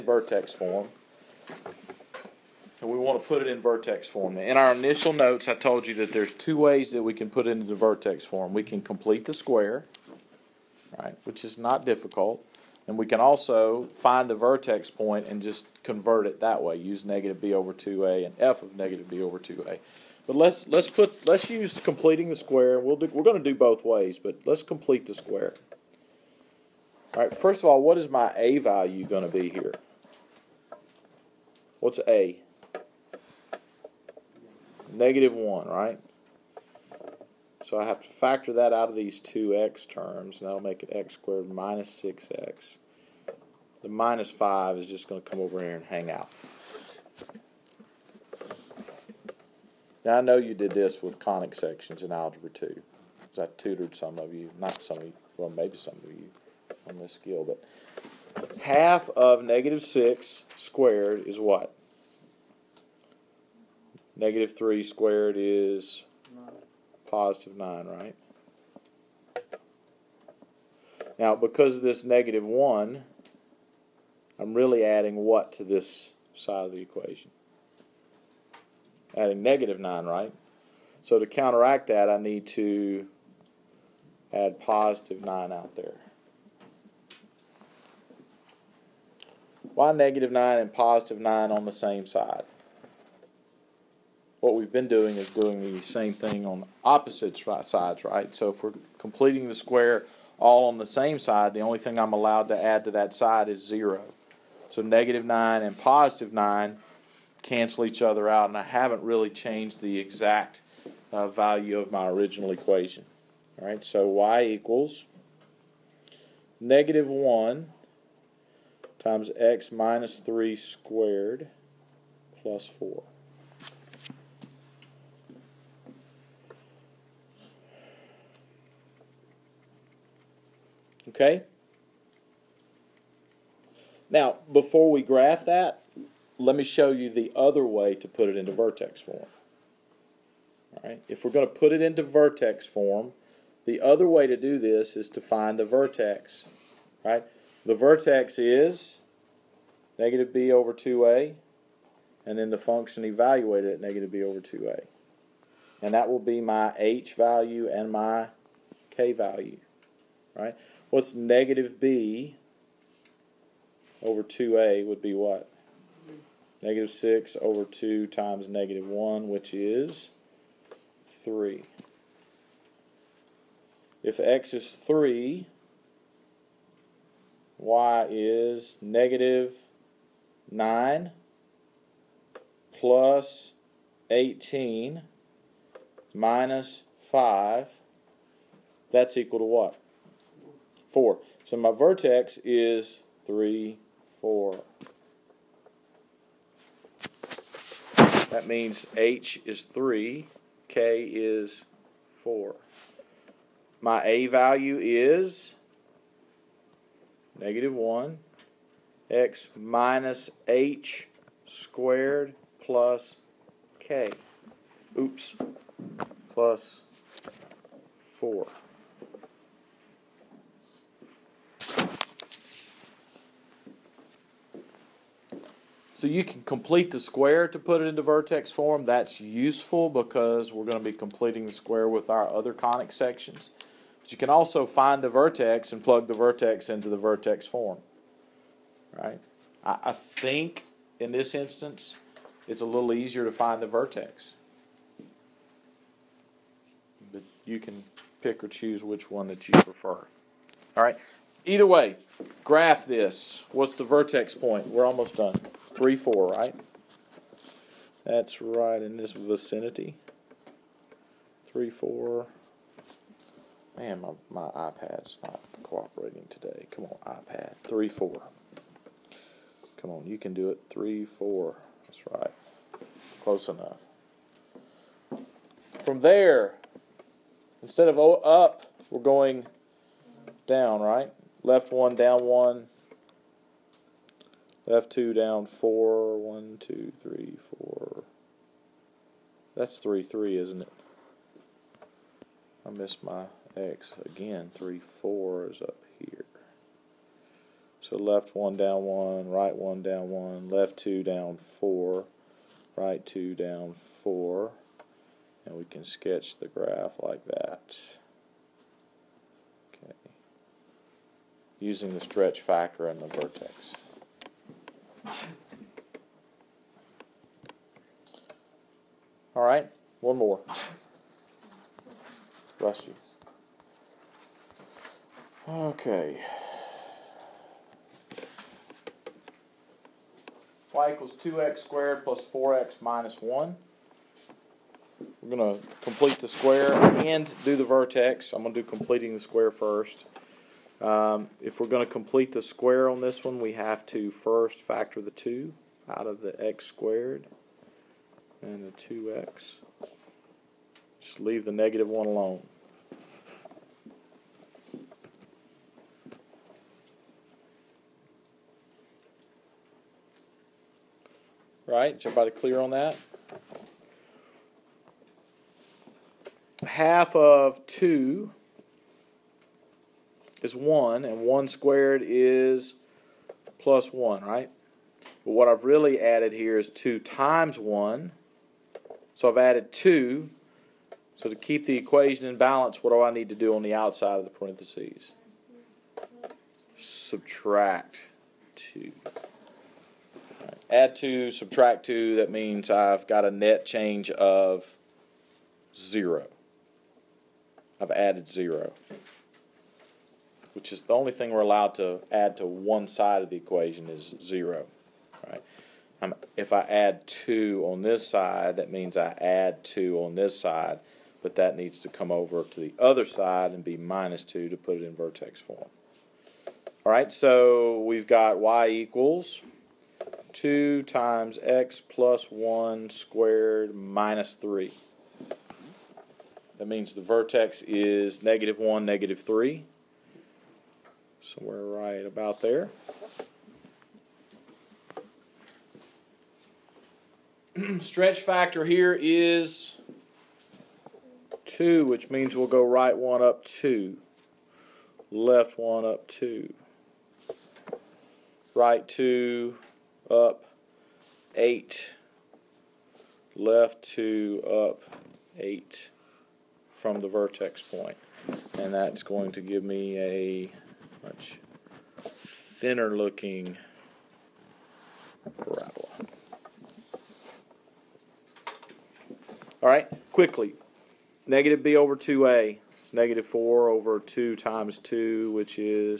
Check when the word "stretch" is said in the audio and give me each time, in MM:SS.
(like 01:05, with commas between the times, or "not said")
05:11, 07:17.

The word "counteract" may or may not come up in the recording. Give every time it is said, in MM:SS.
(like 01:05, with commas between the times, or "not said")
01:21.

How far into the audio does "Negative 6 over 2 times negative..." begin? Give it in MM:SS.
02:46.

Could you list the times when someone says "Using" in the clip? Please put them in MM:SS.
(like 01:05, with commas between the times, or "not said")
05:11.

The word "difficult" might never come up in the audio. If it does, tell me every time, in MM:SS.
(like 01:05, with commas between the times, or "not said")
00:11.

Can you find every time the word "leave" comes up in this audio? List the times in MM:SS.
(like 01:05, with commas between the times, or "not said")
05:51.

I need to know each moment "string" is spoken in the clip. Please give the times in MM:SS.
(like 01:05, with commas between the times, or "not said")
not said.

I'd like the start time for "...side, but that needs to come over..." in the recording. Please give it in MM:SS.
06:50.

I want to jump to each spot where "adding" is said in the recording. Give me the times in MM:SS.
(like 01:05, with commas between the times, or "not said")
01:14, 01:19.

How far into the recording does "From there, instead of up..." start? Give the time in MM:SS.
04:35.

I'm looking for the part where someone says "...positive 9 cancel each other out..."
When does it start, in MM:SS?
01:45.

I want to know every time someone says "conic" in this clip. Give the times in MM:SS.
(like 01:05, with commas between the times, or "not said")
00:51, 03:52.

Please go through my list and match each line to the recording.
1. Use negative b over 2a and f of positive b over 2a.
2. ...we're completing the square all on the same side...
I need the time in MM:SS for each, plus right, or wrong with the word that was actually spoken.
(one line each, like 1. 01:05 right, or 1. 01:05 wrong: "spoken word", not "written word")
1. 00:16 wrong: "negative", not "positive"
2. 01:38 right.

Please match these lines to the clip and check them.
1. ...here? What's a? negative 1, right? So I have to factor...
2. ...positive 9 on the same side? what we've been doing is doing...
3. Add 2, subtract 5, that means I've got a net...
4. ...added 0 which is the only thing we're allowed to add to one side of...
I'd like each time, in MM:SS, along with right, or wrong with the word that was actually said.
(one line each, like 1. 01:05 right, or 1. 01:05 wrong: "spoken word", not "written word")
1. 00:29 right
2. 01:30 right
3. 06:30 wrong: "2", not "5"
4. 06:37 right.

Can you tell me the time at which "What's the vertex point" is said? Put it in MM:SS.
04:13.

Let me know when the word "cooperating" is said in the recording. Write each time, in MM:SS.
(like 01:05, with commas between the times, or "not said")
04:25.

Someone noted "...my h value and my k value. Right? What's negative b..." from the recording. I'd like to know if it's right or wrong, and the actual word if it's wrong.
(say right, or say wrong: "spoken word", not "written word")
right.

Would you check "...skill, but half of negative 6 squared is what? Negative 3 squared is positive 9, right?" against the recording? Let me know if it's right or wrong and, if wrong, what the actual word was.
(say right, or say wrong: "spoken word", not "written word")
right.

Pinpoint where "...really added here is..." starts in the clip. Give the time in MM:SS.
06:15.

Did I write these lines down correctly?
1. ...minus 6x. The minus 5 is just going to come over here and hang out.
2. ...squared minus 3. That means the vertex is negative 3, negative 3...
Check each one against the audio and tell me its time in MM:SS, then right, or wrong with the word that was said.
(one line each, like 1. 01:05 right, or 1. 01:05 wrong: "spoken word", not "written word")
1. 00:41 right
2. 07:02 wrong: "1", not "3".